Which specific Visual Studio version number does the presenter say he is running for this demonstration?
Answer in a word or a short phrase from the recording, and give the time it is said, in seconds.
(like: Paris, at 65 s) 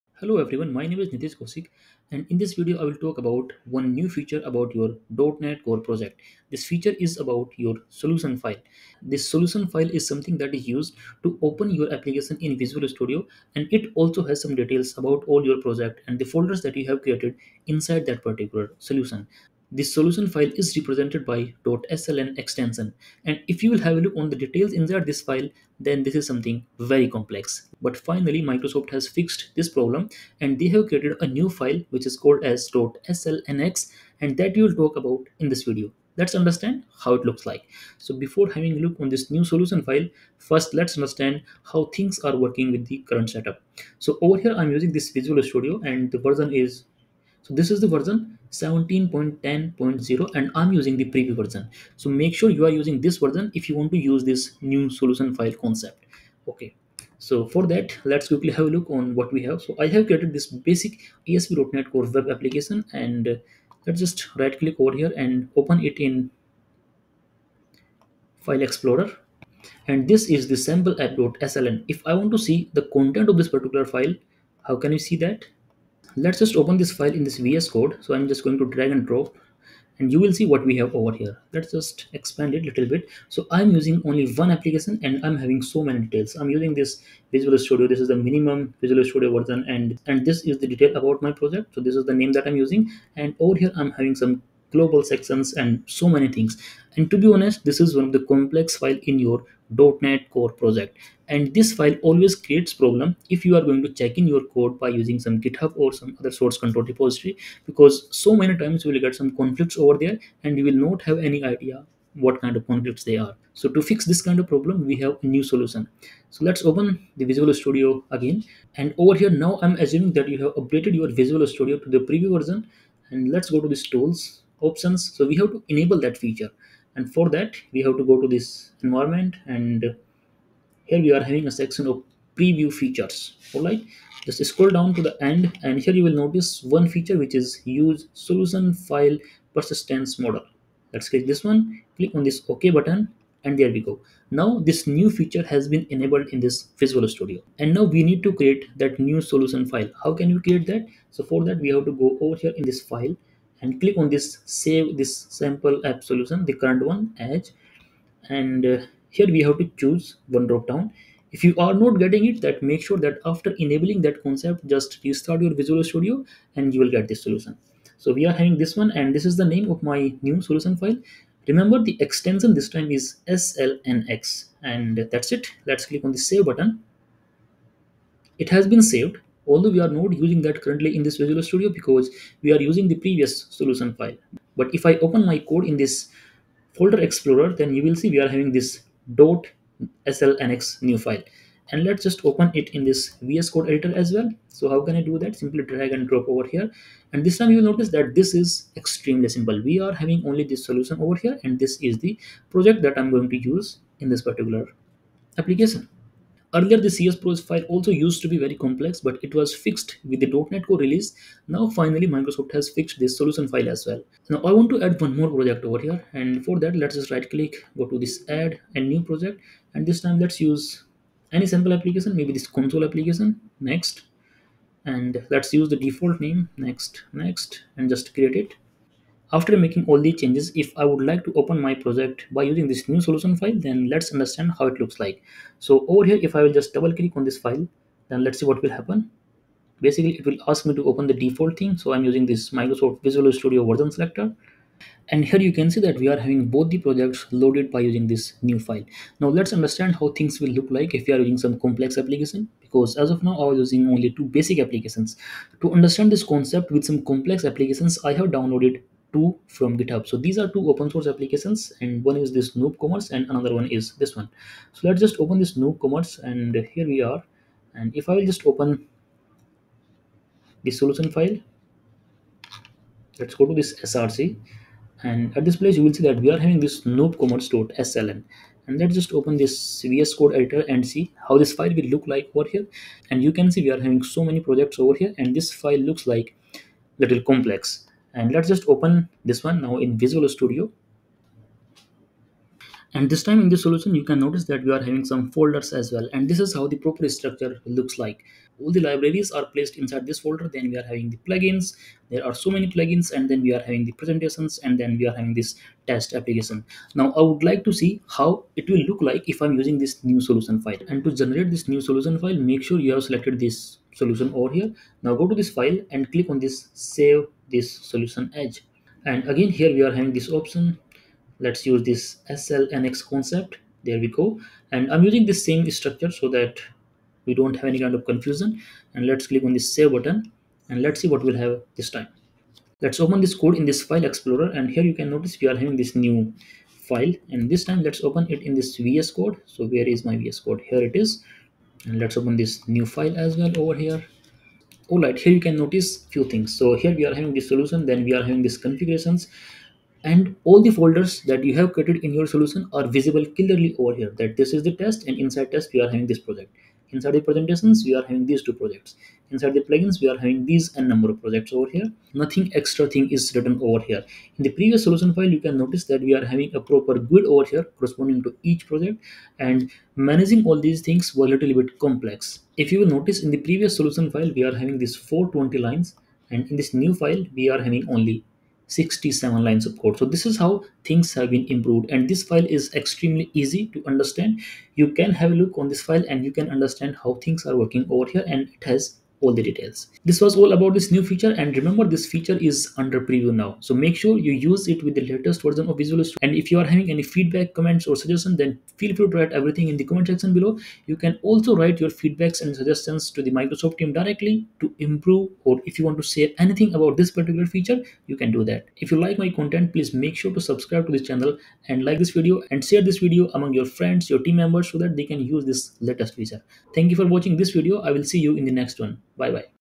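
17.10.0, at 48 s.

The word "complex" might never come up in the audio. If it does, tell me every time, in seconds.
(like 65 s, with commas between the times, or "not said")
27 s, 98 s, 208 s, 251 s, 257 s, 287 s, 371 s.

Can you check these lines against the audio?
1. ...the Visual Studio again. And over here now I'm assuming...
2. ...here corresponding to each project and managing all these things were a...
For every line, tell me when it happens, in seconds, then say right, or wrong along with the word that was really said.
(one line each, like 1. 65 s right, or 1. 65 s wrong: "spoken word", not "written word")
1. 117 s right
2. 367 s right.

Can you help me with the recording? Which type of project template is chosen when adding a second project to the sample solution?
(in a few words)
Console application.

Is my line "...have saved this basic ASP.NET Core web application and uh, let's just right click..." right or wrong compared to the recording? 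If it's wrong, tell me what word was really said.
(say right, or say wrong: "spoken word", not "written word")
wrong: "created", not "saved".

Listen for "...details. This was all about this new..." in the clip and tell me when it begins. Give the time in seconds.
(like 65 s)
389 s.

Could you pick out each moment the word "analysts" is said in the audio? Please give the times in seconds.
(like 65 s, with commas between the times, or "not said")
not said.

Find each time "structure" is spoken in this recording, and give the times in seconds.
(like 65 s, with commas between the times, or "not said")
297 s, 325 s.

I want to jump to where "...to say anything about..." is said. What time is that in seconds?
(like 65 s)
405 s.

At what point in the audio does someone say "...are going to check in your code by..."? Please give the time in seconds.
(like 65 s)
103 s.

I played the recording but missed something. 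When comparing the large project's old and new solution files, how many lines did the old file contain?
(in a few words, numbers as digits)
420.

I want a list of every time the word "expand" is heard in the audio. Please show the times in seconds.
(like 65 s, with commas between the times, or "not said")
82 s.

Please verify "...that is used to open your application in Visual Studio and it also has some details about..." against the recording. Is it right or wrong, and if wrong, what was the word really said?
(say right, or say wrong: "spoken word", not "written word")
right.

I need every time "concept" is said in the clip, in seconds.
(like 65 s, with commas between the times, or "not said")
55 s, 164 s, 256 s, 323 s.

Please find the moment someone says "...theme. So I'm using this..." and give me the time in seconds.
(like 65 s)
241 s.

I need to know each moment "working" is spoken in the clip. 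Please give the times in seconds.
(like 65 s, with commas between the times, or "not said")
42 s, 387 s.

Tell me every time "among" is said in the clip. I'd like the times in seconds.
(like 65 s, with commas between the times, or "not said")
413 s.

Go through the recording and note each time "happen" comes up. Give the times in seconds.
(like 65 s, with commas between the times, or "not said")
238 s.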